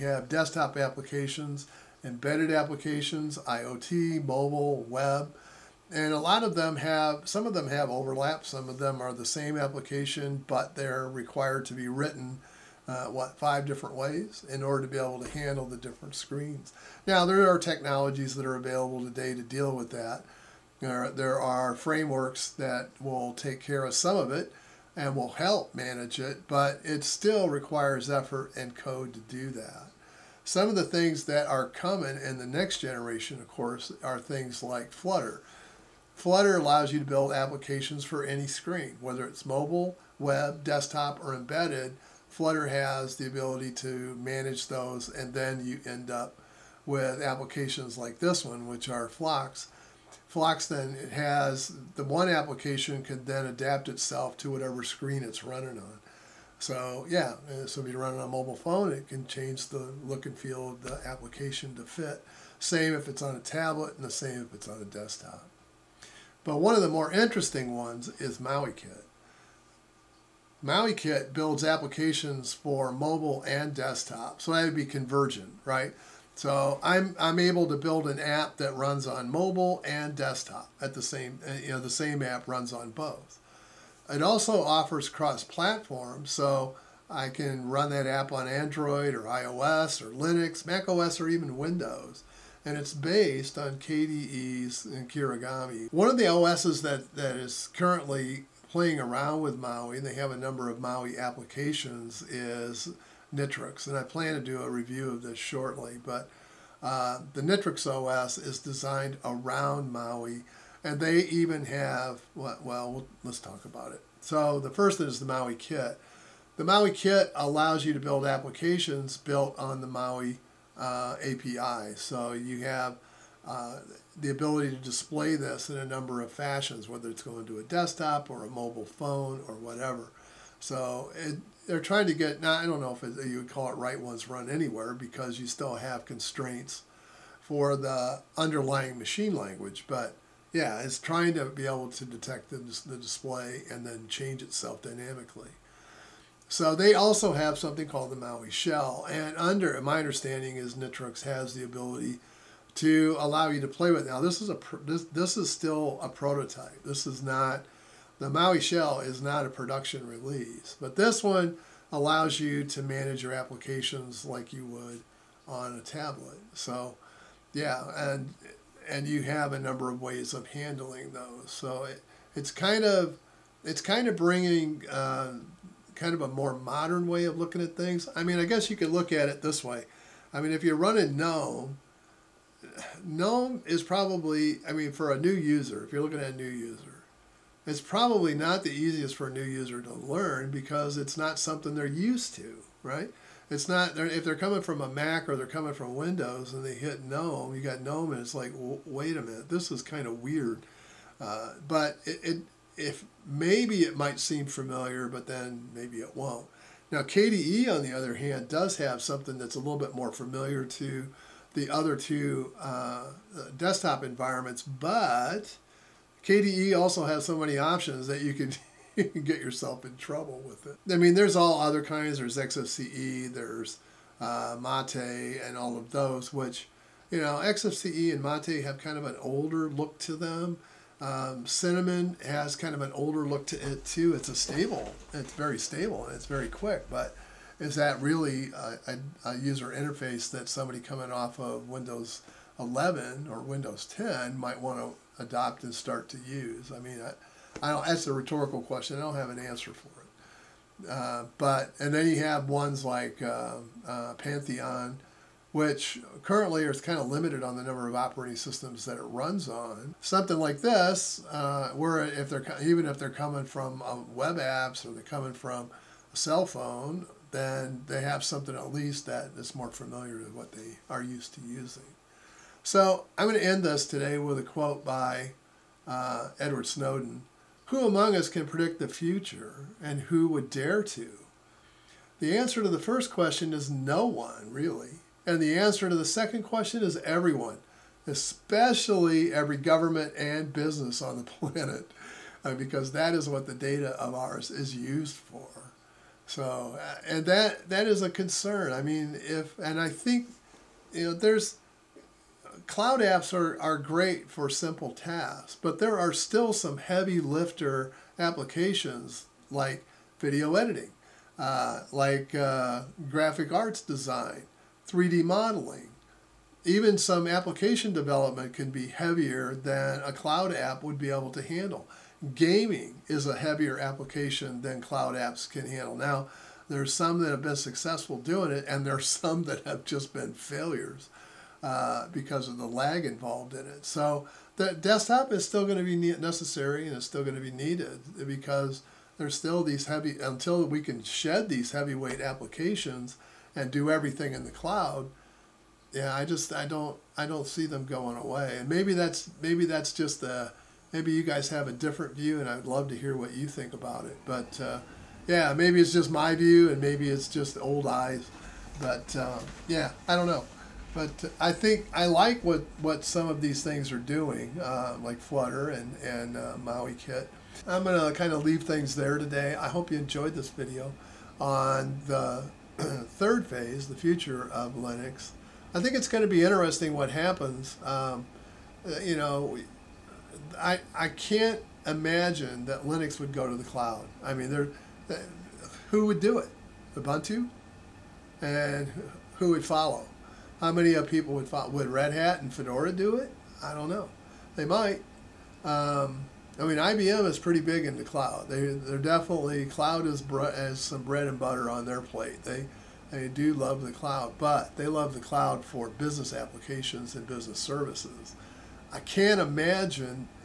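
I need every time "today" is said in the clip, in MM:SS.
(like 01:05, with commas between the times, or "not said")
00:18, 04:33, 06:09.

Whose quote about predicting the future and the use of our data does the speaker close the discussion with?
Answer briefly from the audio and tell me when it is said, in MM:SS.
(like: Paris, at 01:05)
Edward Snowden, at 04:36.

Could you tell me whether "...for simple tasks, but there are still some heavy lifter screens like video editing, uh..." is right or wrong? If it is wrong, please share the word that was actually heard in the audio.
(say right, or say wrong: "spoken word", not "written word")
wrong: "applications", not "screens".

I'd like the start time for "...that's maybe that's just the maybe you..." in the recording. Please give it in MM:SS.
05:48.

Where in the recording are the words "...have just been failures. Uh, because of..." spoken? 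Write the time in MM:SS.
05:29.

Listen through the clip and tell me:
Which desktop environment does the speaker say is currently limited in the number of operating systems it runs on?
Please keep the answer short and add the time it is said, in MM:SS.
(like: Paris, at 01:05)
Pantheon, at 04:14.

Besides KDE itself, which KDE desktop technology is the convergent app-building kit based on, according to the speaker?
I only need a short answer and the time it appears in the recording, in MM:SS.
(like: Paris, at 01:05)
Kirigami, at 01:35.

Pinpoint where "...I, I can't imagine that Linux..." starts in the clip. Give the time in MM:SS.
06:20.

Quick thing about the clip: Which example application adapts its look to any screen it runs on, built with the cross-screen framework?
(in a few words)
Flox.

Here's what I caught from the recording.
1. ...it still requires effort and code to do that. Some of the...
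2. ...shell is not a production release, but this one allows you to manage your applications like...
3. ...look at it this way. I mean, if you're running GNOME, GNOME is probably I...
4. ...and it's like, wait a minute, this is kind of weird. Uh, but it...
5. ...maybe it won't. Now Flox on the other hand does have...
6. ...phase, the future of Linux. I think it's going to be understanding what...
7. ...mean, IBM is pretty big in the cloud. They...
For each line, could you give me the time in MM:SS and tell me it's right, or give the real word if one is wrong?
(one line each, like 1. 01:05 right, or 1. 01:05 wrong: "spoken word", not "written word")
1. 00:26 right
2. 02:38 right
3. 02:58 right
4. 03:18 right
5. 03:25 wrong: "KDE", not "Flox"
6. 06:13 wrong: "interesting", not "understanding"
7. 06:36 right.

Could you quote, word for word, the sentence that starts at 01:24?
It also offers cross-platform, so I can run that app on Android or iOS or Linux, Mac OS or even Windows.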